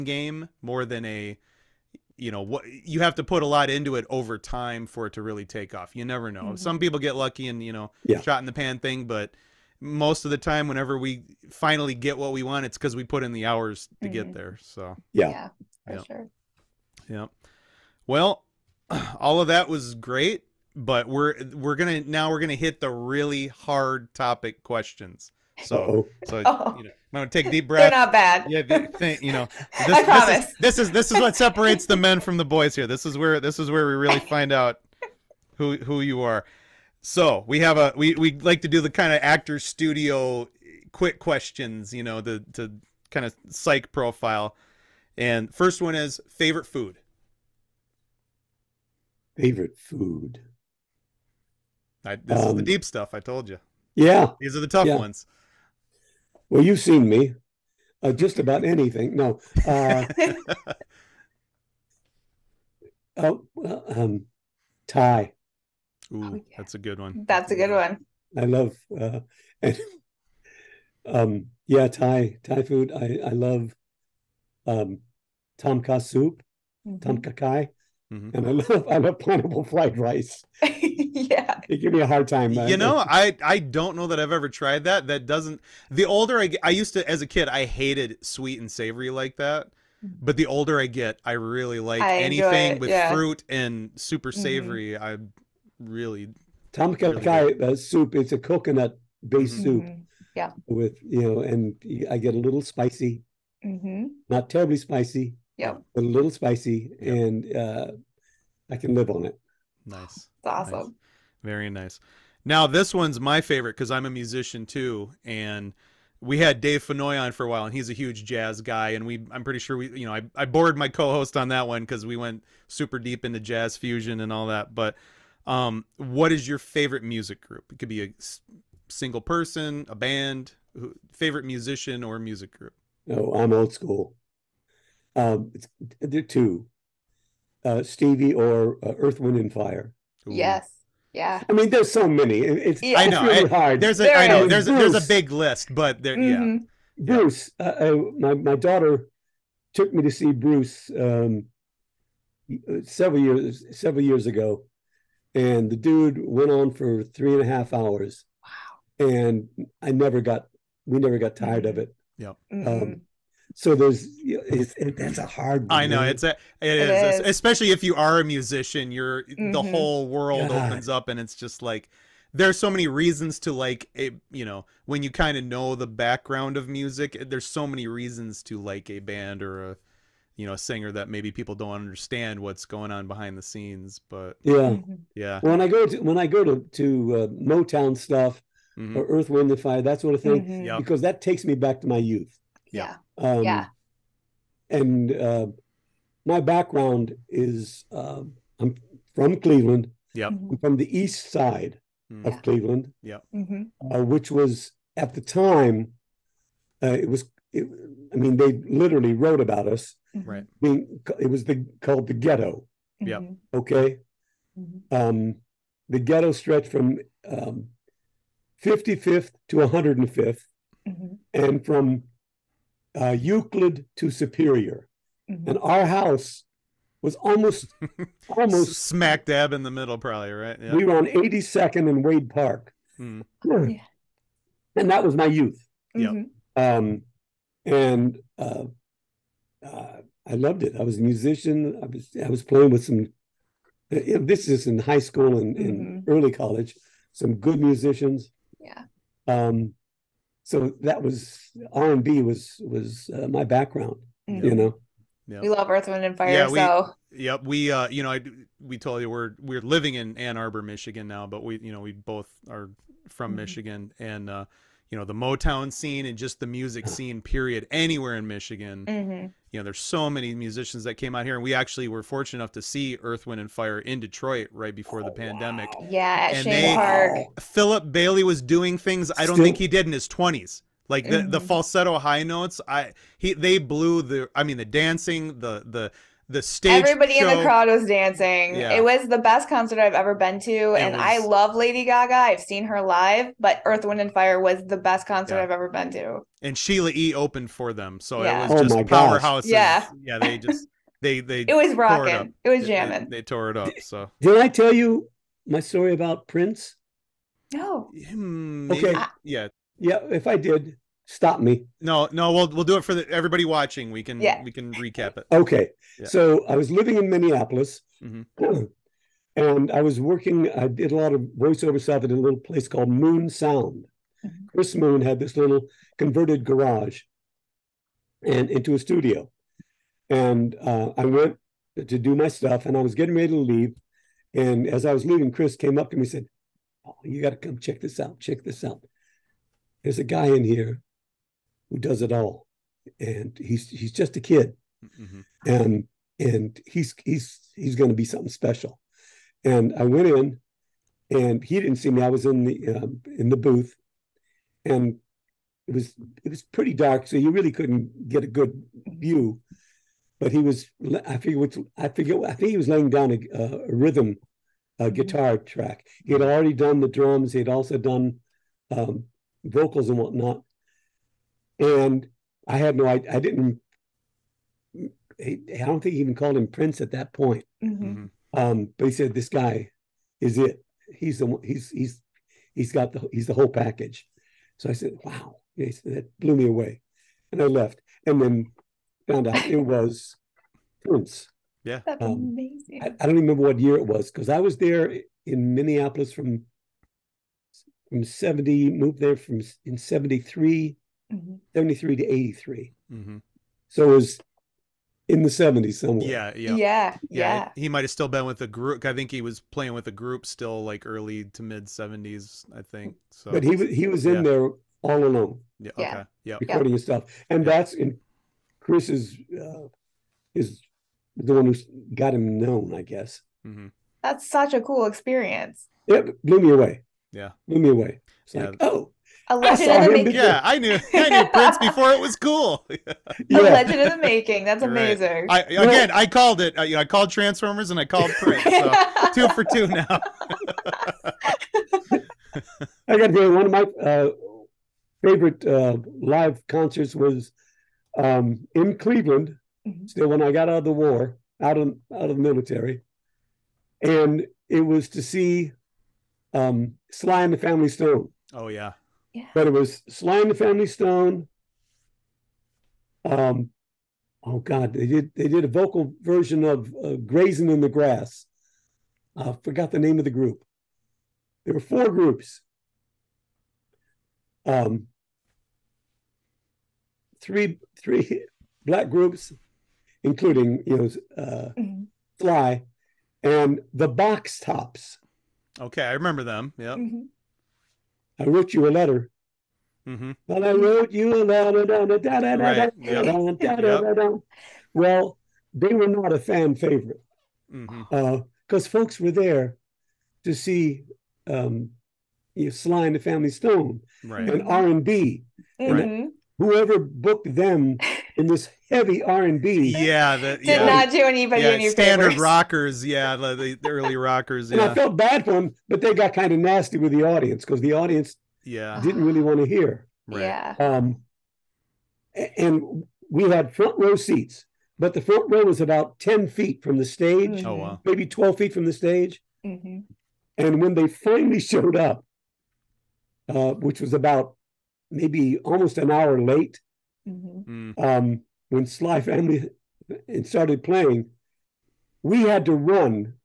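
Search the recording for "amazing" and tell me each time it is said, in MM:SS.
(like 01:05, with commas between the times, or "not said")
06:32, 07:14.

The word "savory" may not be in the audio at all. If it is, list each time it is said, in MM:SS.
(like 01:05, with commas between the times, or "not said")
01:28, 01:34.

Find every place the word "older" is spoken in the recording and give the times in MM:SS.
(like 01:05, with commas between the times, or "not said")
01:26, 01:30.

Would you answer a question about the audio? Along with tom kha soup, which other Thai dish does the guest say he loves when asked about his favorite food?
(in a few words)
pineapple fried rice.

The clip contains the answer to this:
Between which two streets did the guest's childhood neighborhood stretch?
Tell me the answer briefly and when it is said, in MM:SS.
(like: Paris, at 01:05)
Euclid to Superior, at 03:43.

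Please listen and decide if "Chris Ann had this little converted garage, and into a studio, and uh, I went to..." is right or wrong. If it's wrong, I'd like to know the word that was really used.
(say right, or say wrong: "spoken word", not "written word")
wrong: "Moon", not "Ann".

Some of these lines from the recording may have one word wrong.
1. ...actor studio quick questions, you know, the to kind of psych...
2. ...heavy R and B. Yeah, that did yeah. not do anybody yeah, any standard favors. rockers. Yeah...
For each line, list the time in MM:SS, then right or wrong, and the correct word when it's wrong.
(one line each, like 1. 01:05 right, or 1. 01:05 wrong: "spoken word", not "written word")
1. 00:39 right
2. 08:28 right.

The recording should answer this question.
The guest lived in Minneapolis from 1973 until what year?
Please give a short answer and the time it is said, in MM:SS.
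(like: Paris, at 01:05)
1983, at 06:42.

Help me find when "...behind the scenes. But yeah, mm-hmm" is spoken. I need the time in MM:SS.
03:03.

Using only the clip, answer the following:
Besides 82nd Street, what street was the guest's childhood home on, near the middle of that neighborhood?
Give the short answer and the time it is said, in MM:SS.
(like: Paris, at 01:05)
Wade Park, at 03:52.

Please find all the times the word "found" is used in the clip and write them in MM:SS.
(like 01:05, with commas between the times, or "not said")
06:29.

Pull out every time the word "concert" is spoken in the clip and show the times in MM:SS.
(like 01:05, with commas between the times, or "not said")
04:49, 04:55, 07:26.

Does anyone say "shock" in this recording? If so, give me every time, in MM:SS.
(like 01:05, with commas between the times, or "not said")
not said.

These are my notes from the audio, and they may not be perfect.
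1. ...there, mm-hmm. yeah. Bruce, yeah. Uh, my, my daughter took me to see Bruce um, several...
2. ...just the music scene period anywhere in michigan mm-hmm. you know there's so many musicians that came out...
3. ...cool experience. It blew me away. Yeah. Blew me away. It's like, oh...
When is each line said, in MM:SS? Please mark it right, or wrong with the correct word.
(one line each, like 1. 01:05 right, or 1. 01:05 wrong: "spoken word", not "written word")
1. 02:26 right
2. 04:26 right
3. 07:04 right.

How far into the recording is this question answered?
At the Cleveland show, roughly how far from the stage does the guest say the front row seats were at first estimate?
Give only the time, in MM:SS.
08:45.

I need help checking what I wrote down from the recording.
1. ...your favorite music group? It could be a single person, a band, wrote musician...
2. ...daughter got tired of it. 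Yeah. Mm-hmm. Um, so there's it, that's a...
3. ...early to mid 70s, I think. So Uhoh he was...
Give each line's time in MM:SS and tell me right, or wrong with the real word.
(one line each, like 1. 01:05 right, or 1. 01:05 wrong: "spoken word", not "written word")
1. 02:06 wrong: "favorite", not "wrote"
2. 02:40 wrong: "never", not "daughter"
3. 06:50 wrong: "But", not "Uhoh".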